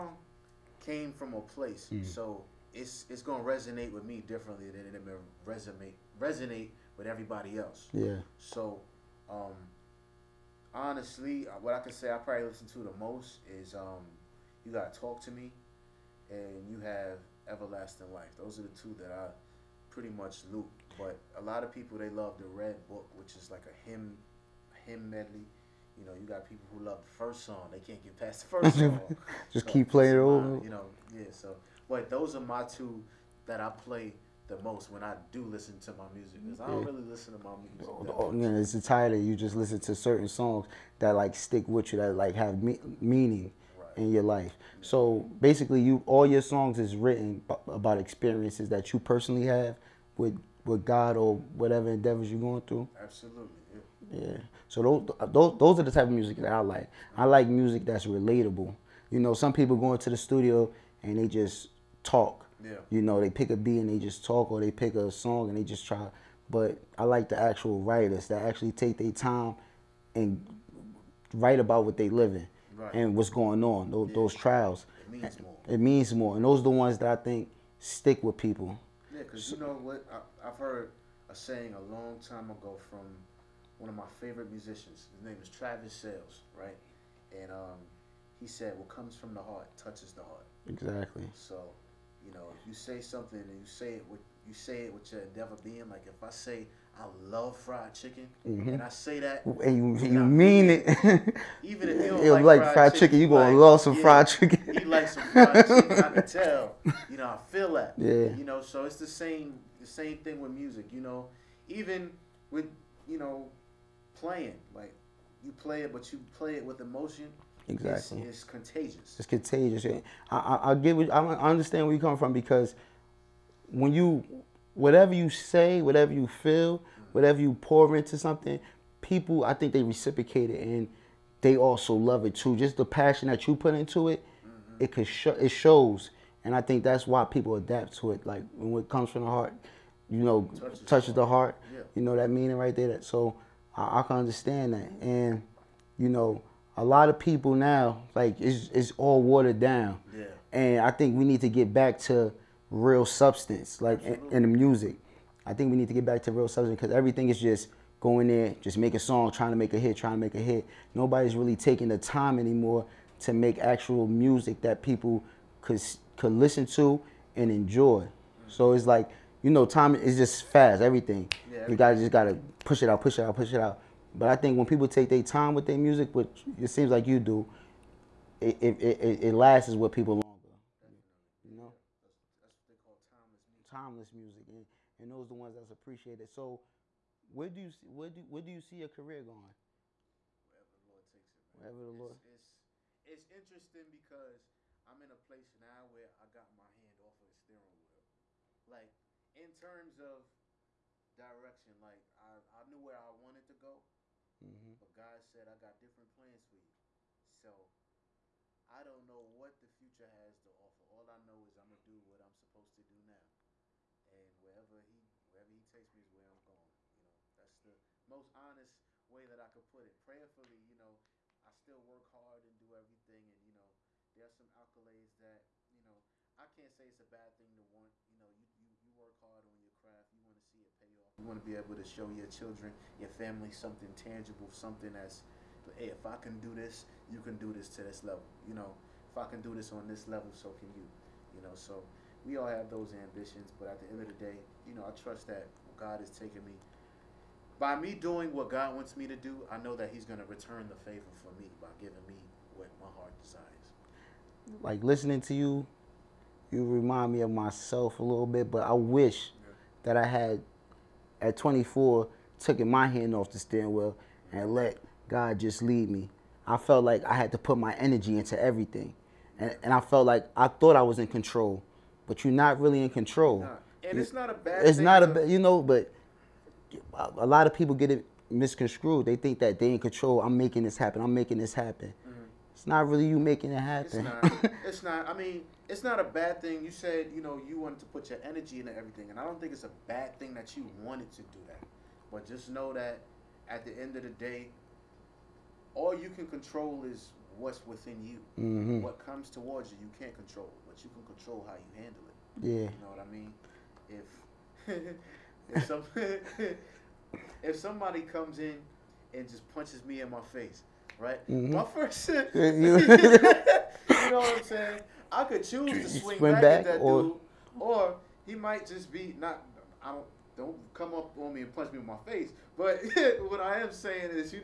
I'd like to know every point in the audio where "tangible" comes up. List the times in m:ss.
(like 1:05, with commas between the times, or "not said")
3:53.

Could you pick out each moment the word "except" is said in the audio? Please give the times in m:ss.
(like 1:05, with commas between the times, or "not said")
not said.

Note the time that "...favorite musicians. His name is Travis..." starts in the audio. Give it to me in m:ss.
1:24.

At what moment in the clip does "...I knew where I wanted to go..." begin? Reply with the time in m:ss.
3:22.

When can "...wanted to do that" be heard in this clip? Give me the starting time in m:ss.
4:50.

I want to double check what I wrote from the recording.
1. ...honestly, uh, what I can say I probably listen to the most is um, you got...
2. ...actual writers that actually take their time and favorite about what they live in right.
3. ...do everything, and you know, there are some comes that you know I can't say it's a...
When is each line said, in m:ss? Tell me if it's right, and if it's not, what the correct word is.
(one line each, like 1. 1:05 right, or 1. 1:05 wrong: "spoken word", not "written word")
1. 0:10 right
2. 1:07 wrong: "write", not "favorite"
3. 3:42 wrong: "accolades", not "comes".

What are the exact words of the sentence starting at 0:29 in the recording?
Just so keep playing it over.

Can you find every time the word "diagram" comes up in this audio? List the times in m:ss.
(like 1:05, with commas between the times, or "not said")
not said.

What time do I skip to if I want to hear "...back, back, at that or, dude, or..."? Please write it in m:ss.
5:16.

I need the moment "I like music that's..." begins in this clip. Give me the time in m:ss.
0:57.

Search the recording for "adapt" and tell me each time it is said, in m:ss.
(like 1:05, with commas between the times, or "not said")
2:17.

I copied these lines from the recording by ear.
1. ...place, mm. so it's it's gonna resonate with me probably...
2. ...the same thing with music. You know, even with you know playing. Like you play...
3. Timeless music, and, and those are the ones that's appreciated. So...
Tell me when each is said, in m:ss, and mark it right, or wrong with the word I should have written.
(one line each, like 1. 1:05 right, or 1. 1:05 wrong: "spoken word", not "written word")
1. 0:01 wrong: "differently", not "probably"
2. 1:49 right
3. 3:03 right.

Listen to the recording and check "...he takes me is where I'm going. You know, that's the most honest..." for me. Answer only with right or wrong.
right.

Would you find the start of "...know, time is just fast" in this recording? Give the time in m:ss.
2:49.